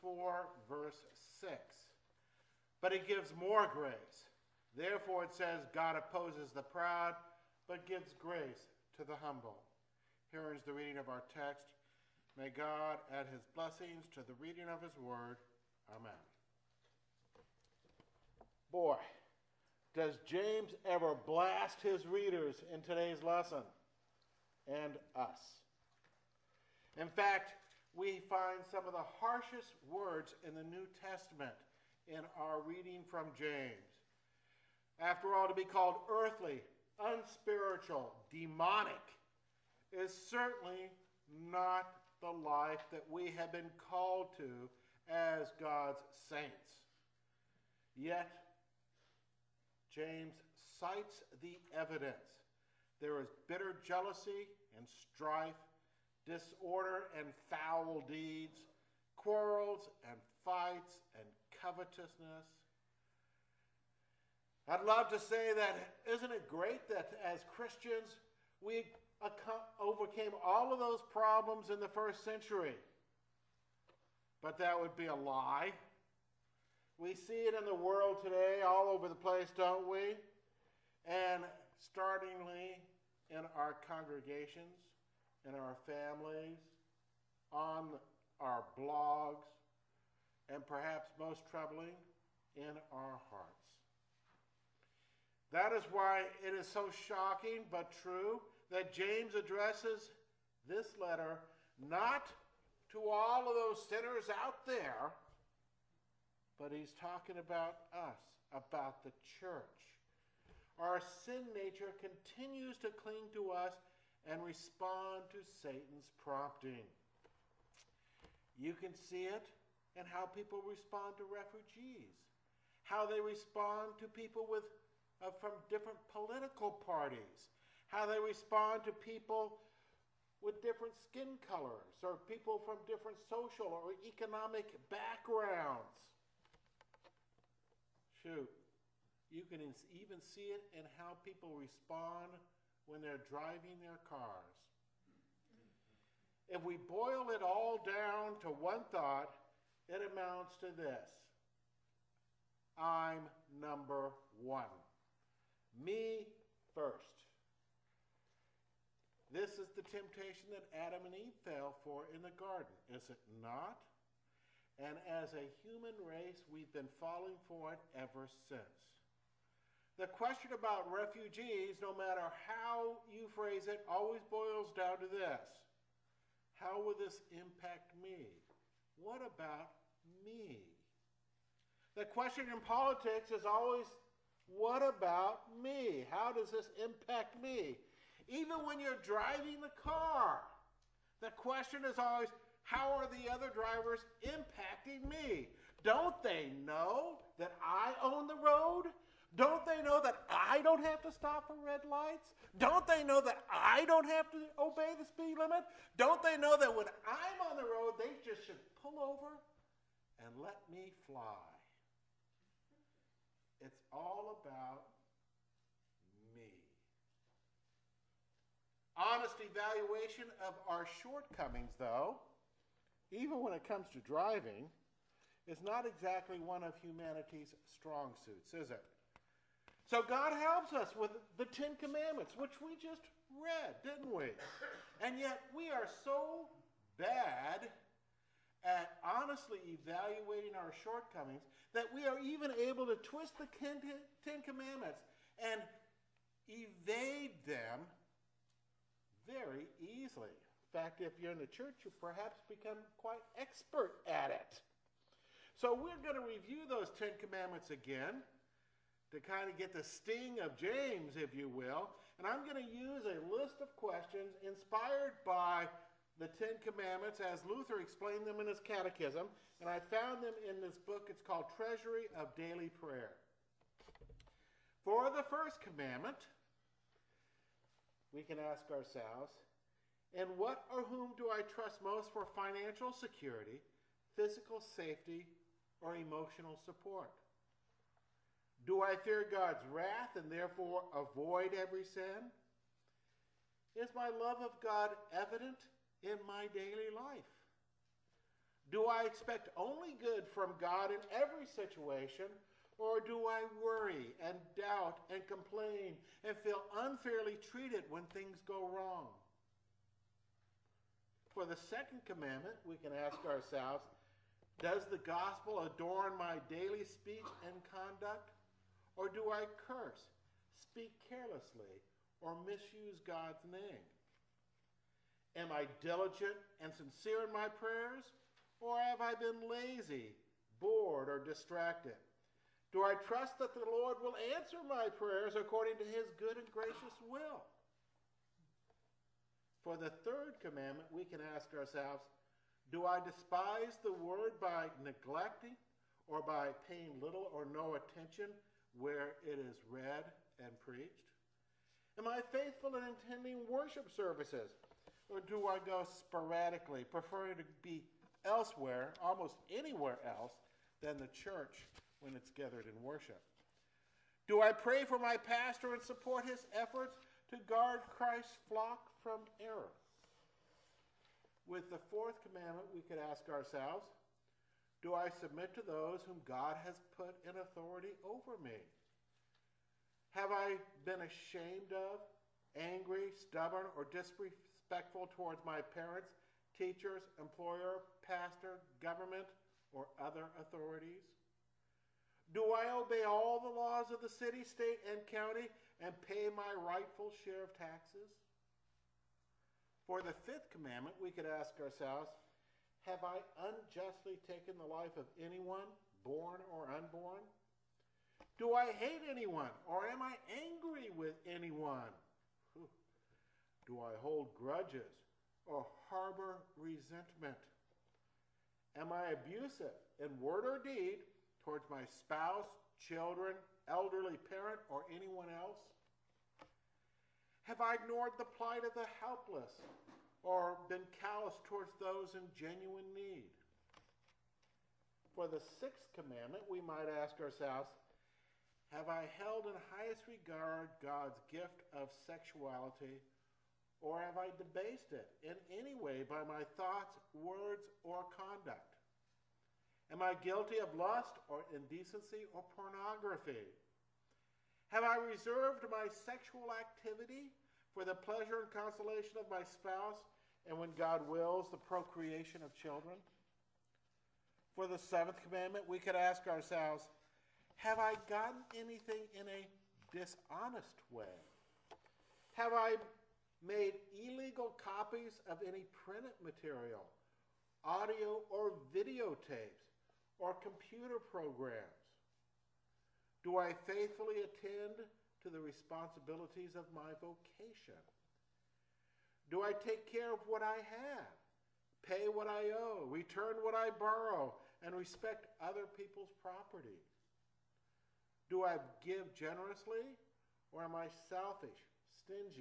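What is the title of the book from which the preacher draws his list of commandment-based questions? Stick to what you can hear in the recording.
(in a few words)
Treasury of Daily Prayer.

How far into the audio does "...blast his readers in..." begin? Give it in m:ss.
0:21.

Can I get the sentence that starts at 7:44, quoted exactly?
For the seventh commandment, we could ask ourselves Have I gotten anything in a dishonest way?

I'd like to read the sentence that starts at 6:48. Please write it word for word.
Do I hate anyone, or am I angry with anyone?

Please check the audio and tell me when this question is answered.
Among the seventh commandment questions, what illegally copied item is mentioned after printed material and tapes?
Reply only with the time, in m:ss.
8:00.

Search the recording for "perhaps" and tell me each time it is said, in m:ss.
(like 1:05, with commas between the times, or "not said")
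1:30, 4:12.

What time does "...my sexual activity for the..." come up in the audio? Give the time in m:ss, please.
7:35.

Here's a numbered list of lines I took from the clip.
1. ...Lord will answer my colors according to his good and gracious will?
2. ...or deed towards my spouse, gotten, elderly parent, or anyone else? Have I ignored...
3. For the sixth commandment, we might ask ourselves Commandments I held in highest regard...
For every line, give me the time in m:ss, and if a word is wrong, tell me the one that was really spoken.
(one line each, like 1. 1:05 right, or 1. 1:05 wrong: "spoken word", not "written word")
1. 5:33 wrong: "prayers", not "colors"
2. 7:00 wrong: "children", not "gotten"
3. 7:15 wrong: "Have", not "Commandments".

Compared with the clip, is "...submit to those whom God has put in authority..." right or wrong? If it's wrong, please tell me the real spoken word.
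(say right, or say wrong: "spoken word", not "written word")
right.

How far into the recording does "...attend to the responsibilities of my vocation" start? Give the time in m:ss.
8:04.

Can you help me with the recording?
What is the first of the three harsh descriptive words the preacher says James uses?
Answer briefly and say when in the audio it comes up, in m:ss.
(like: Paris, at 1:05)
Earthly, at 0:36.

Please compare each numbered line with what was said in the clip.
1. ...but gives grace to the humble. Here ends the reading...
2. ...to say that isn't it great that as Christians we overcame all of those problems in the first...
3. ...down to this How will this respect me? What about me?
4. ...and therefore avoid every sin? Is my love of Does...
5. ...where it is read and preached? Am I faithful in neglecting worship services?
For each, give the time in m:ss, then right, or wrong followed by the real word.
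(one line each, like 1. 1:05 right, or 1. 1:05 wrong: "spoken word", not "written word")
1. 0:07 right
2. 1:05 right
3. 2:54 wrong: "impact", not "respect"
4. 4:50 wrong: "God", not "Does"
5. 5:48 wrong: "attending", not "neglecting".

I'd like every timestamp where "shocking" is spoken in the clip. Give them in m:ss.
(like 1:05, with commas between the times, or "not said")
1:37.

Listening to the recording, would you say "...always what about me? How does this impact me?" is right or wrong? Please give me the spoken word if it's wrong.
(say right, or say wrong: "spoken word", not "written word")
right.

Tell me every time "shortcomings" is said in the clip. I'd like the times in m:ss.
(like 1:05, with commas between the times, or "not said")
3:41, 4:00.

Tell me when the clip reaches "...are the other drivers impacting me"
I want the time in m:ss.
3:12.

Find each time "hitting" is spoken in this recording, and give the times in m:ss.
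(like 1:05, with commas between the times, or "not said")
not said.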